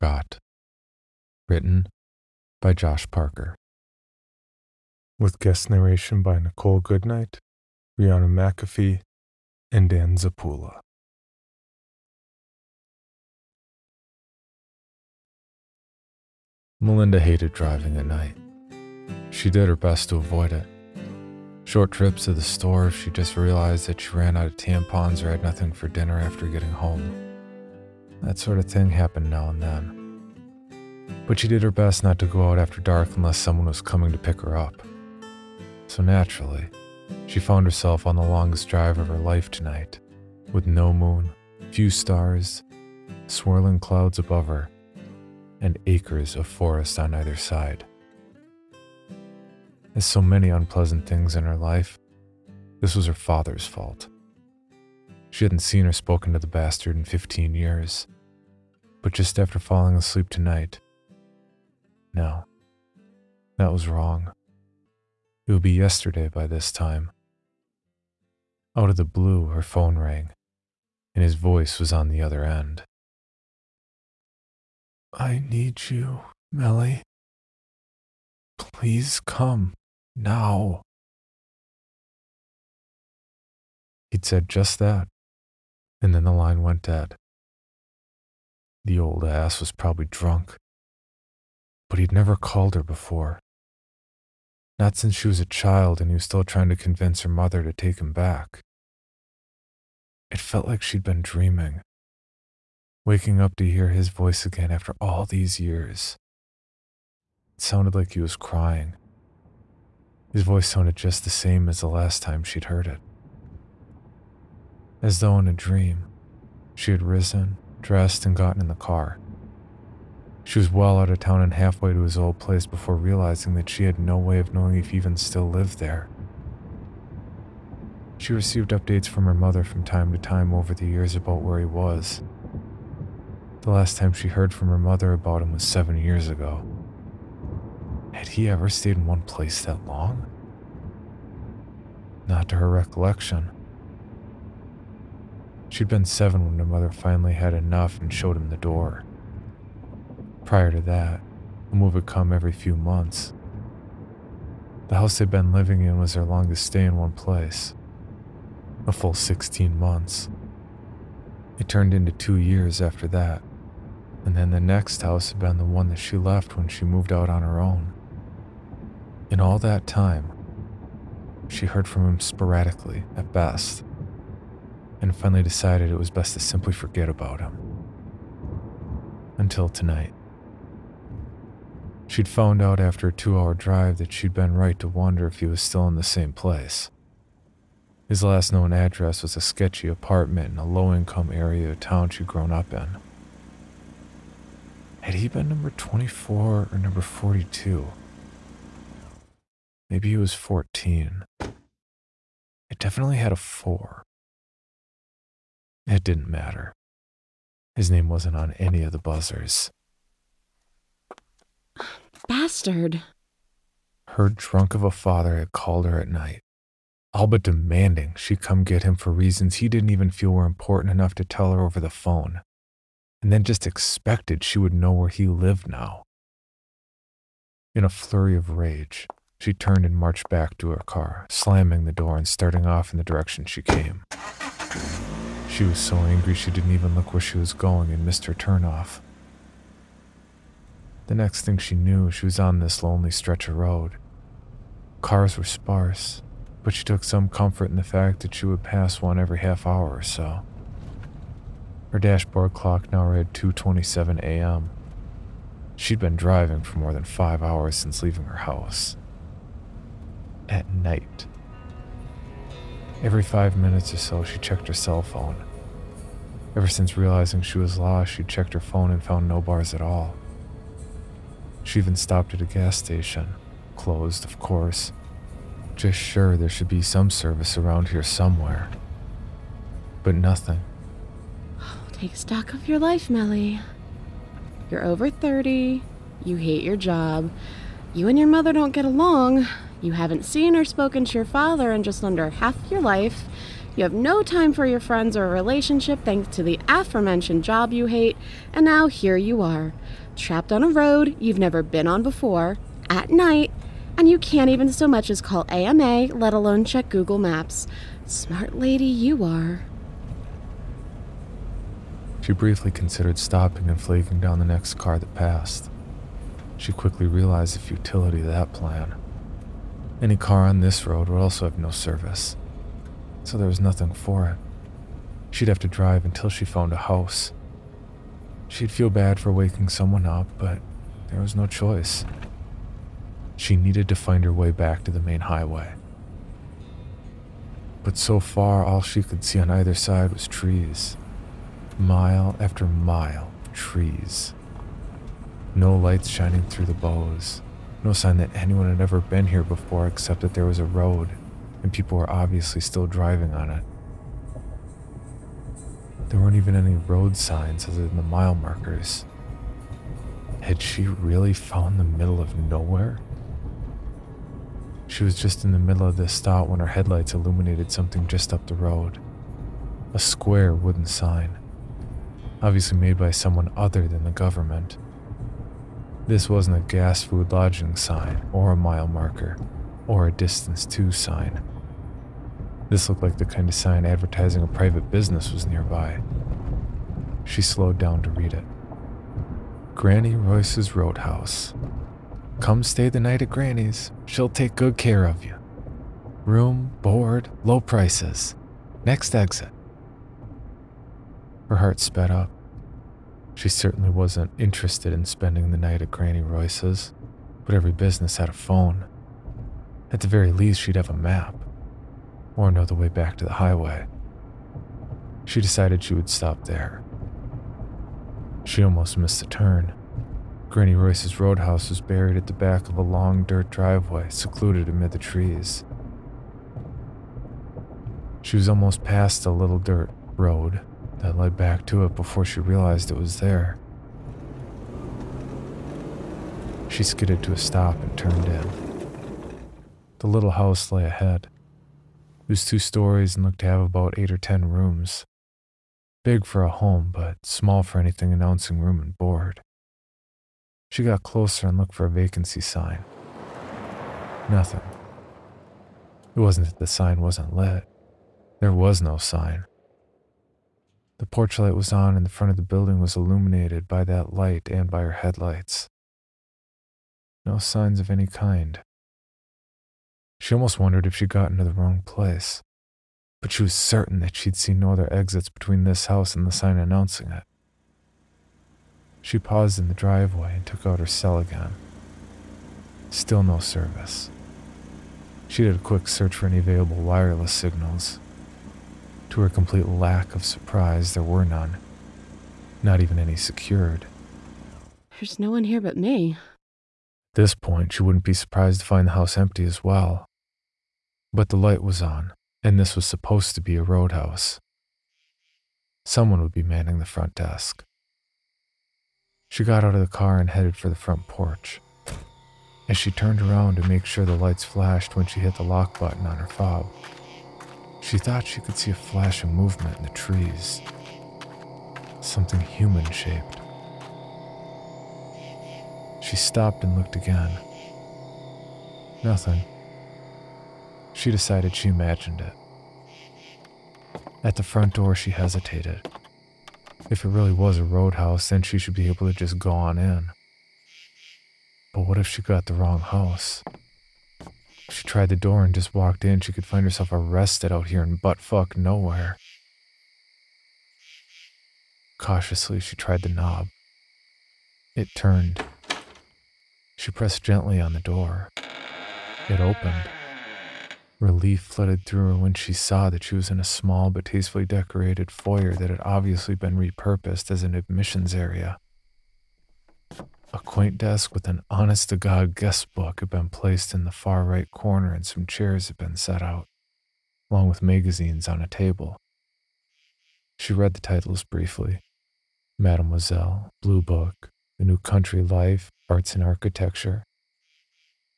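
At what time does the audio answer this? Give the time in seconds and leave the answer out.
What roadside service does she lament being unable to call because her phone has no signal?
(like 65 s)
305 s.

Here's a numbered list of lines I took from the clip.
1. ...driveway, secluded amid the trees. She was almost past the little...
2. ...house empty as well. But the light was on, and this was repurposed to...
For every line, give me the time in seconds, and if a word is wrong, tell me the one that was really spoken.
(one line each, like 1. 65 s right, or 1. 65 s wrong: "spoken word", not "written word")
1. 423 s right
2. 498 s wrong: "supposed", not "repurposed".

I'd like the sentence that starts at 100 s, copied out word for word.
It felt like she'd been dreaming, waking up to hear his voice again after all these years.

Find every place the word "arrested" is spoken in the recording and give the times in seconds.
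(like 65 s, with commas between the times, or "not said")
546 s.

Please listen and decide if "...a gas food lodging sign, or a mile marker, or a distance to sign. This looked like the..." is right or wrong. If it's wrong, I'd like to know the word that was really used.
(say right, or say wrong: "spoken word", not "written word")
right.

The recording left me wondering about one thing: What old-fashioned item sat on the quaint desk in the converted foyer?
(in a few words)
guest book.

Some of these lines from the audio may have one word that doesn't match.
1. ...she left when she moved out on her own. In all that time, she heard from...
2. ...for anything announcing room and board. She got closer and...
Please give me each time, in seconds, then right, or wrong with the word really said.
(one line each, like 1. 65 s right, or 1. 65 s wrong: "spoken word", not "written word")
1. 165 s right
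2. 447 s right.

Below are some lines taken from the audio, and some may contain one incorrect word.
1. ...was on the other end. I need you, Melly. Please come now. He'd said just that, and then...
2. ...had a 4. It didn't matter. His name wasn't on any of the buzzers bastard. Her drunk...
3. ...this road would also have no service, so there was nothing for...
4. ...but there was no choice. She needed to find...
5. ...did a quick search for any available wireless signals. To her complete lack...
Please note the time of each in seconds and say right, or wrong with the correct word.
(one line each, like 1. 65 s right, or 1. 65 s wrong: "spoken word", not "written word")
1. 71 s right
2. 203 s right
3. 320 s right
4. 330 s right
5. 485 s right.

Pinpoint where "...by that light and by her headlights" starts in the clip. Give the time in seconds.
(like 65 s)
463 s.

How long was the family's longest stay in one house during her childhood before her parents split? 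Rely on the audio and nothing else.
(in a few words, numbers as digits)
16 months.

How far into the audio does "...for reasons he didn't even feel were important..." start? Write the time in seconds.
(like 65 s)
218 s.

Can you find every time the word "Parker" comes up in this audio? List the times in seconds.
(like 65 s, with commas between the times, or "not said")
3 s.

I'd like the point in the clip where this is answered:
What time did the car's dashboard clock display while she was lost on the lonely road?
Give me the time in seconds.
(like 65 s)
253 s.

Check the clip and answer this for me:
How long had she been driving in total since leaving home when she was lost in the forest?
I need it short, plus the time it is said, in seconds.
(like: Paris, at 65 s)
more than 5 hours, at 256 s.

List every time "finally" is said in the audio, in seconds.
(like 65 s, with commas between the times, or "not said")
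146 s, 175 s.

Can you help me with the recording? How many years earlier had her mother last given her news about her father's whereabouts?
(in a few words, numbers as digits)
7.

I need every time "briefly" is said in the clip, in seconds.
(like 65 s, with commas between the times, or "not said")
312 s, 581 s.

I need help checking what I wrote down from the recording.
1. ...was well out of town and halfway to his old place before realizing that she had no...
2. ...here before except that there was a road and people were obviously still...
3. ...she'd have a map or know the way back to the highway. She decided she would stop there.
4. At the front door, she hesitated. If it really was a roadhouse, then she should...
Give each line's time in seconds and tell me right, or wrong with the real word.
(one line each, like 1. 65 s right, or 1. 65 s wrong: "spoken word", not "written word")
1. 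120 s right
2. 349 s right
3. 410 s right
4. 534 s right.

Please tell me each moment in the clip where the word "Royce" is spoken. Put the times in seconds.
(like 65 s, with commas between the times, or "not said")
390 s, 406 s, 420 s.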